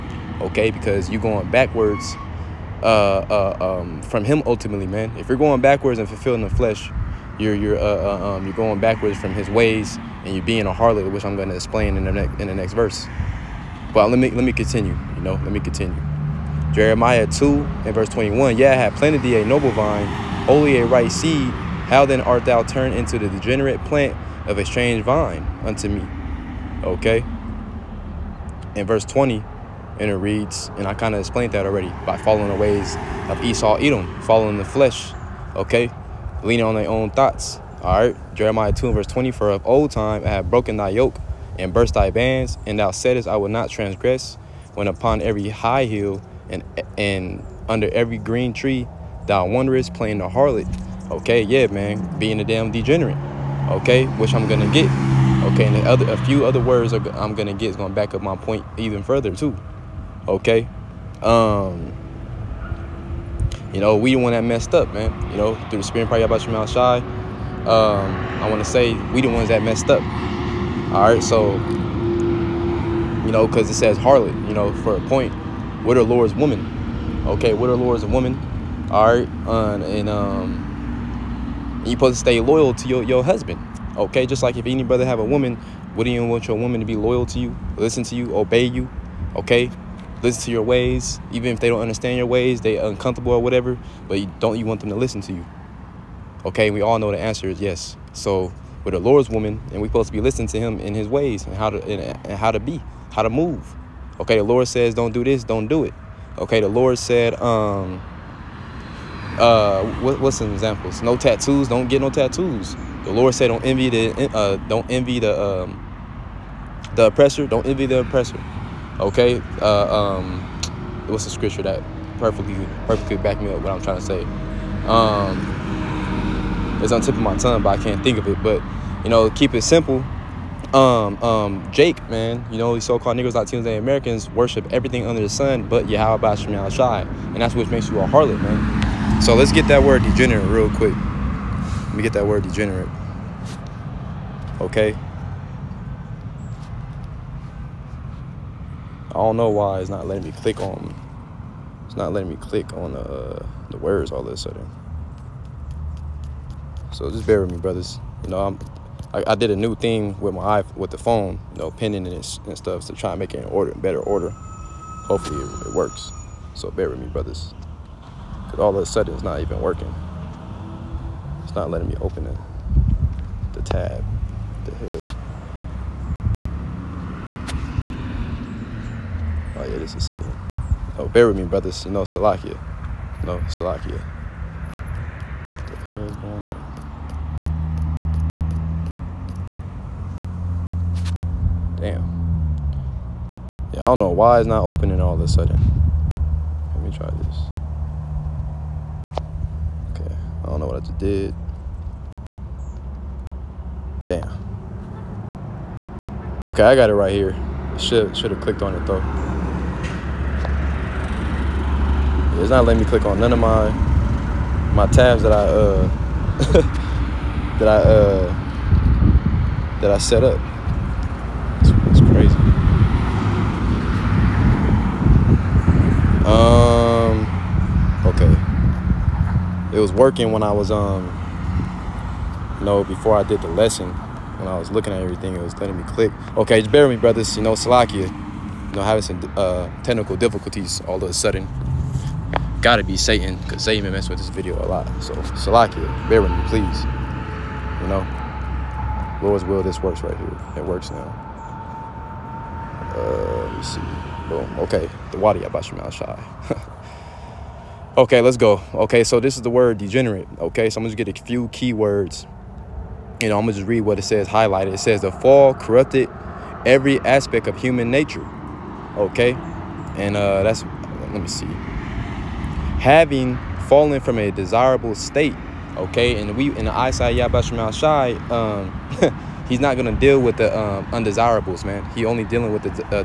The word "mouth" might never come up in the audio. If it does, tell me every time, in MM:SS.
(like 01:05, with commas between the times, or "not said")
01:06.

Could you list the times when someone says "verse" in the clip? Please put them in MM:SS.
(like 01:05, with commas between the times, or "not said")
00:12, 00:17, 00:28, 00:38.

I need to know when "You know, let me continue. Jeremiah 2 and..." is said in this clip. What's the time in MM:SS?
00:15.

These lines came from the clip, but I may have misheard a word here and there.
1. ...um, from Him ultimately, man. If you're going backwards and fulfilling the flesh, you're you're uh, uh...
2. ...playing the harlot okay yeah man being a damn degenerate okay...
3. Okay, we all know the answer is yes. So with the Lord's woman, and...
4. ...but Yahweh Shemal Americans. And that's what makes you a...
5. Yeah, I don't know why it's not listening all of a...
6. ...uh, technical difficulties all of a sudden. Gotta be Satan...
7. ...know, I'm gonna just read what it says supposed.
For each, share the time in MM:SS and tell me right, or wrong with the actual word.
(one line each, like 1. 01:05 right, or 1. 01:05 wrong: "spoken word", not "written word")
1. 00:03 right
2. 00:49 right
3. 01:36 right
4. 02:15 wrong: "Shai", not "Americans"
5. 03:13 wrong: "opening", not "listening"
6. 03:59 right
7. 04:23 wrong: "highlighted", not "supposed".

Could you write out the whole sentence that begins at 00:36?
Leaning on their own thoughts, all right?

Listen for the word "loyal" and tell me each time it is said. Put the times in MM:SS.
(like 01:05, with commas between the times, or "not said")
01:22, 01:26.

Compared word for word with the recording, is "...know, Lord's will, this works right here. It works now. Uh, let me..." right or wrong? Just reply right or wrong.
right.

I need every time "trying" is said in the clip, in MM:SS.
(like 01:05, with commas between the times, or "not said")
02:03.